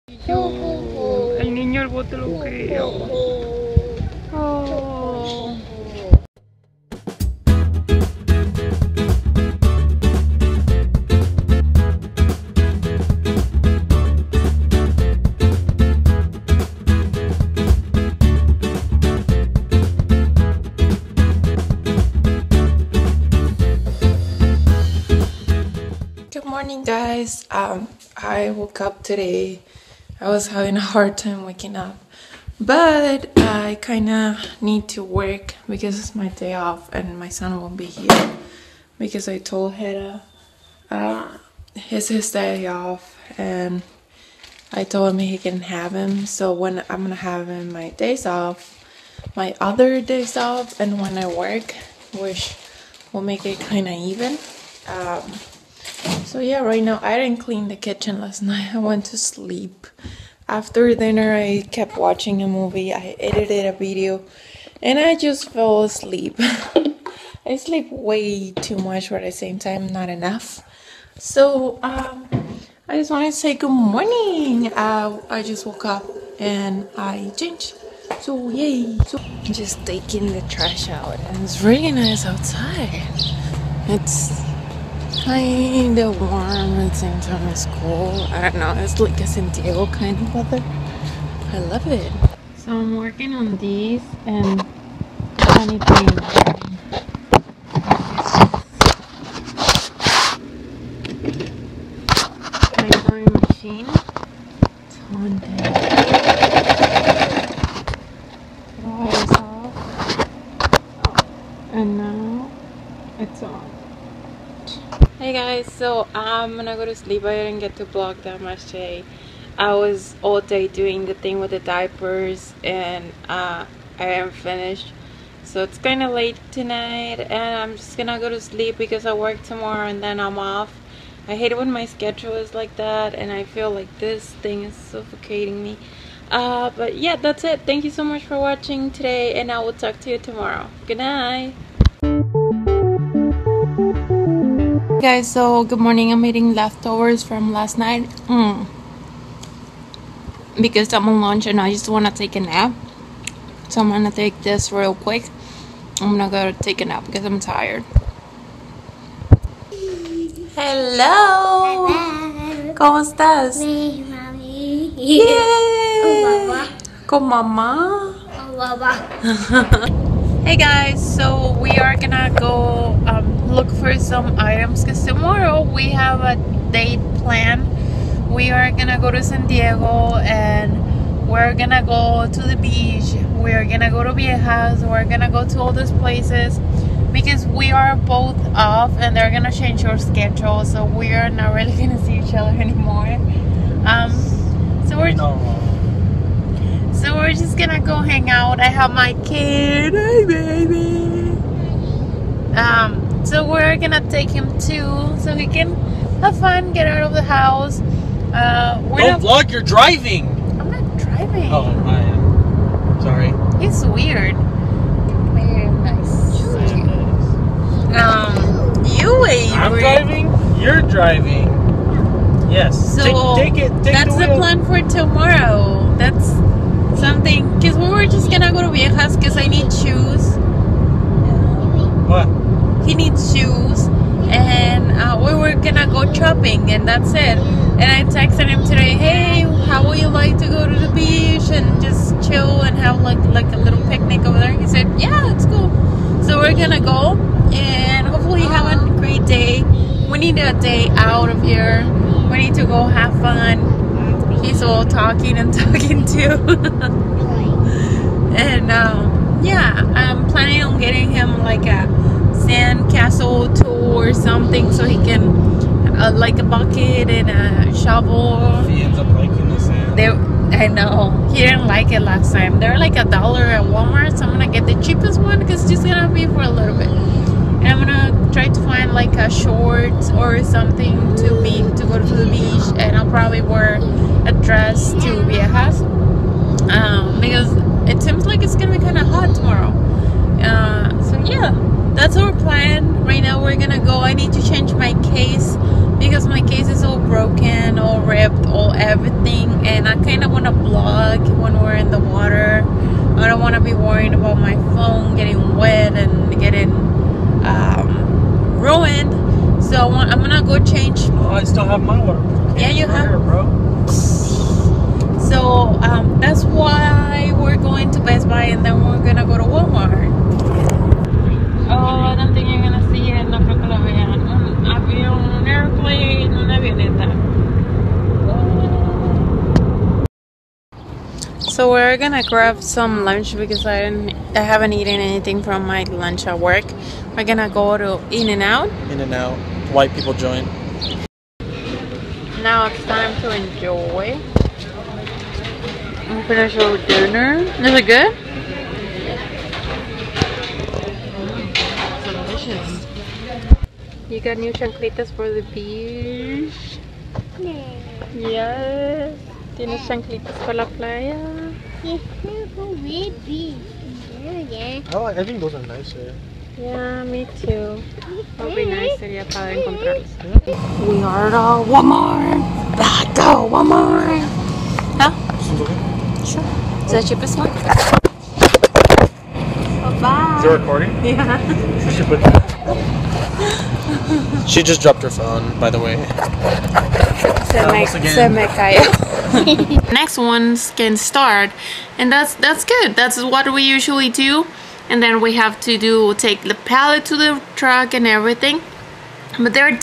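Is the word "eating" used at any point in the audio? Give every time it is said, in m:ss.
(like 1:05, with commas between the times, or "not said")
2:26.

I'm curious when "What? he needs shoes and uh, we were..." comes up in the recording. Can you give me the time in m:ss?
3:52.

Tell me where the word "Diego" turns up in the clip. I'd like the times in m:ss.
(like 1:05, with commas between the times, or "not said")
1:29, 2:59.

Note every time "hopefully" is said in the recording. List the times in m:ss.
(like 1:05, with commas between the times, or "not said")
4:08.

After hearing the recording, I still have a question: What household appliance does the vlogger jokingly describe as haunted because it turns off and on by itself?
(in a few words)
Sewing machine.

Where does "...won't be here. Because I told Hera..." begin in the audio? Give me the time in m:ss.
0:37.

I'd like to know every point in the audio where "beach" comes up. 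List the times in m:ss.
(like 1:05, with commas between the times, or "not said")
3:02, 4:00, 4:42, 5:55.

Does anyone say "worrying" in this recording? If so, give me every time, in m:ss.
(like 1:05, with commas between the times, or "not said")
5:03.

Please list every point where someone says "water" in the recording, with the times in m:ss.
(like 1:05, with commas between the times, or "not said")
5:01, 5:12.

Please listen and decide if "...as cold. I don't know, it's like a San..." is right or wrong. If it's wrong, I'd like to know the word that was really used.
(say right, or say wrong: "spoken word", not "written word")
right.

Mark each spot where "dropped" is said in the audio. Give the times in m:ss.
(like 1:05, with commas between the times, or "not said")
6:24.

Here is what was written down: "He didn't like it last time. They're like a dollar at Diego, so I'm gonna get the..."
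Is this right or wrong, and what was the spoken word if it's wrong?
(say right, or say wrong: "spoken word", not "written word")
wrong: "Walmart", not "Diego".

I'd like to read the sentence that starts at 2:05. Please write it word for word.
So it's kind of late tonight and I'm just gonna go to sleep because I work tomorrow and then I'm off.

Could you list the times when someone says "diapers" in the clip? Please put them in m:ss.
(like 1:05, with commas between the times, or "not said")
2:01.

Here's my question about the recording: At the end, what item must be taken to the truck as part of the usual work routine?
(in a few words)
The pallet.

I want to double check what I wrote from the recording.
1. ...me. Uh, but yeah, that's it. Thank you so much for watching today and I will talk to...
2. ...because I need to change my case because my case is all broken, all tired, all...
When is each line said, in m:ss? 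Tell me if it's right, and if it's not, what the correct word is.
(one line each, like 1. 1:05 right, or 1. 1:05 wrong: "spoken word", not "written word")
1. 2:15 right
2. 4:47 wrong: "ripped", not "tired".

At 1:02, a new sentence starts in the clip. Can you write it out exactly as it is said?
I edited a video, and I just fell asleep.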